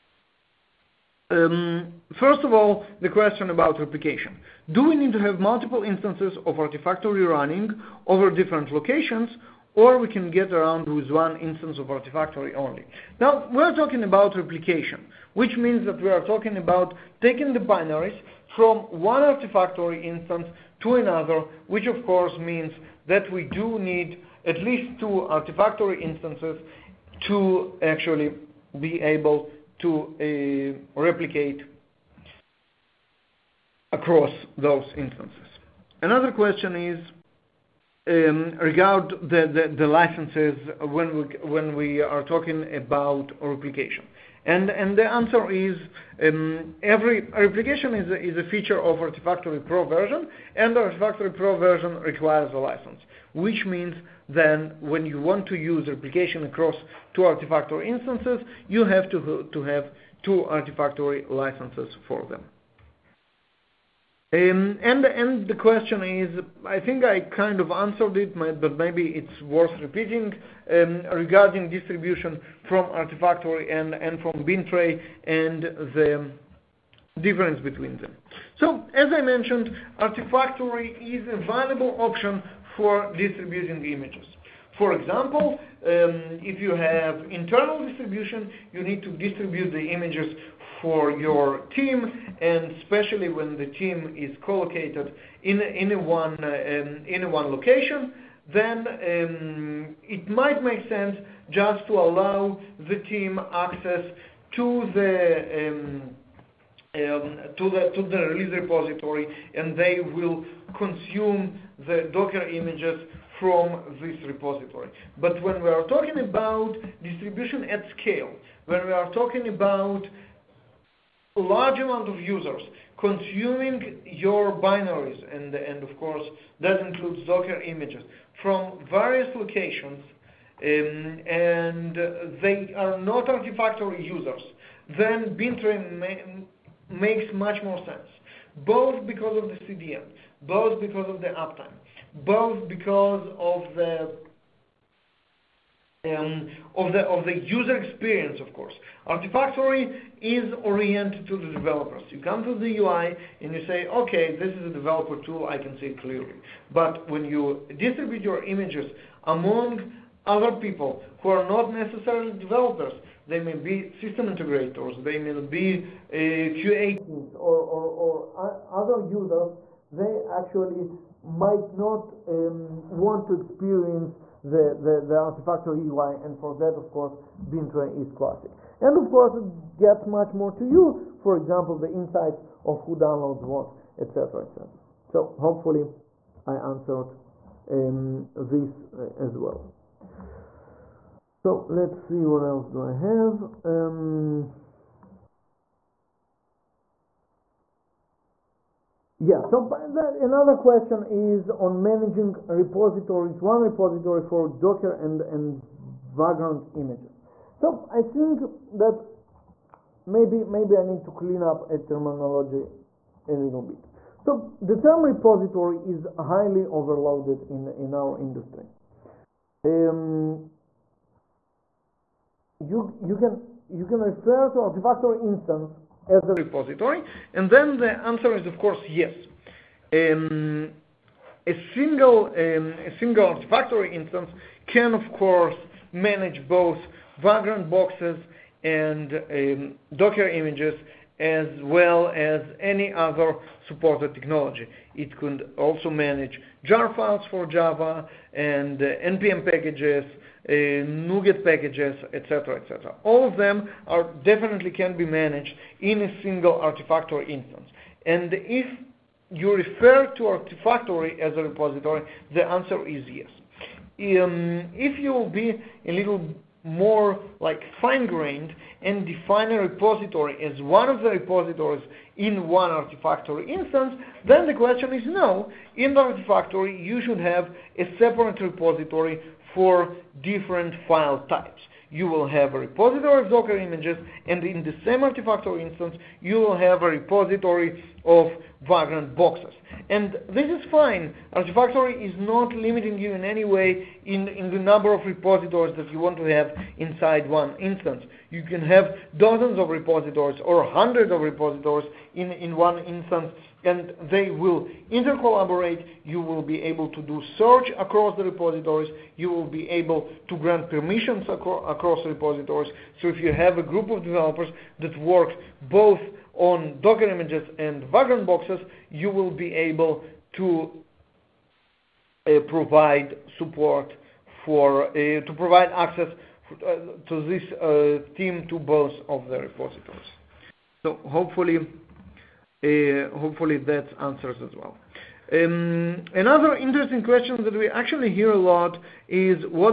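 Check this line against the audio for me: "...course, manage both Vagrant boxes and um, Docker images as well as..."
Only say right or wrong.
right.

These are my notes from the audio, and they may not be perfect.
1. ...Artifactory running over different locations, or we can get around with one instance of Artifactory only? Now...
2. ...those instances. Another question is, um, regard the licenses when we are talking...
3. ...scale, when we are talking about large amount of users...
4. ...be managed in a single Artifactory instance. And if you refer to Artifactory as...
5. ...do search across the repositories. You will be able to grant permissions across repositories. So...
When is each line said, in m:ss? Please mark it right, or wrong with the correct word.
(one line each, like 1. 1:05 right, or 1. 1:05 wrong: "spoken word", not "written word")
1. 0:06 right
2. 0:34 right
3. 1:58 right
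4. 4:14 right
5. 5:07 right.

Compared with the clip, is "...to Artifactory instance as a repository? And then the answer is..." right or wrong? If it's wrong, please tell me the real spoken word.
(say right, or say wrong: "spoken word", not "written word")
right.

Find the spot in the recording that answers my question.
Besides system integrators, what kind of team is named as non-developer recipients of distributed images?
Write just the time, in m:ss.
2:46.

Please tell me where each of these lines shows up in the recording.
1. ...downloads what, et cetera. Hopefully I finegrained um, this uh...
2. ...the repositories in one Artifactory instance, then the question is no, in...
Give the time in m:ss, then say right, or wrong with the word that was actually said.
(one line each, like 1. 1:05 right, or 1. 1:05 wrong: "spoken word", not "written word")
1. 3:02 wrong: "answered", not "finegrained"
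2. 4:31 right.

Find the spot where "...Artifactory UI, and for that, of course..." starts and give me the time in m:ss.
2:55.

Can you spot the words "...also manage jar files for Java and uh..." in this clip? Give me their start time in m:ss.
4:05.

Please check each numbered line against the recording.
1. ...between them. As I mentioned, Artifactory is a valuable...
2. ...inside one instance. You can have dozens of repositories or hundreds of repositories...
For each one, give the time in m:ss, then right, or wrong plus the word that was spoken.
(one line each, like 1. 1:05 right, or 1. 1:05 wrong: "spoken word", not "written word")
1. 1:17 right
2. 4:56 right.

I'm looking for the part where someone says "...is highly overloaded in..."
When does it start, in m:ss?
3:35.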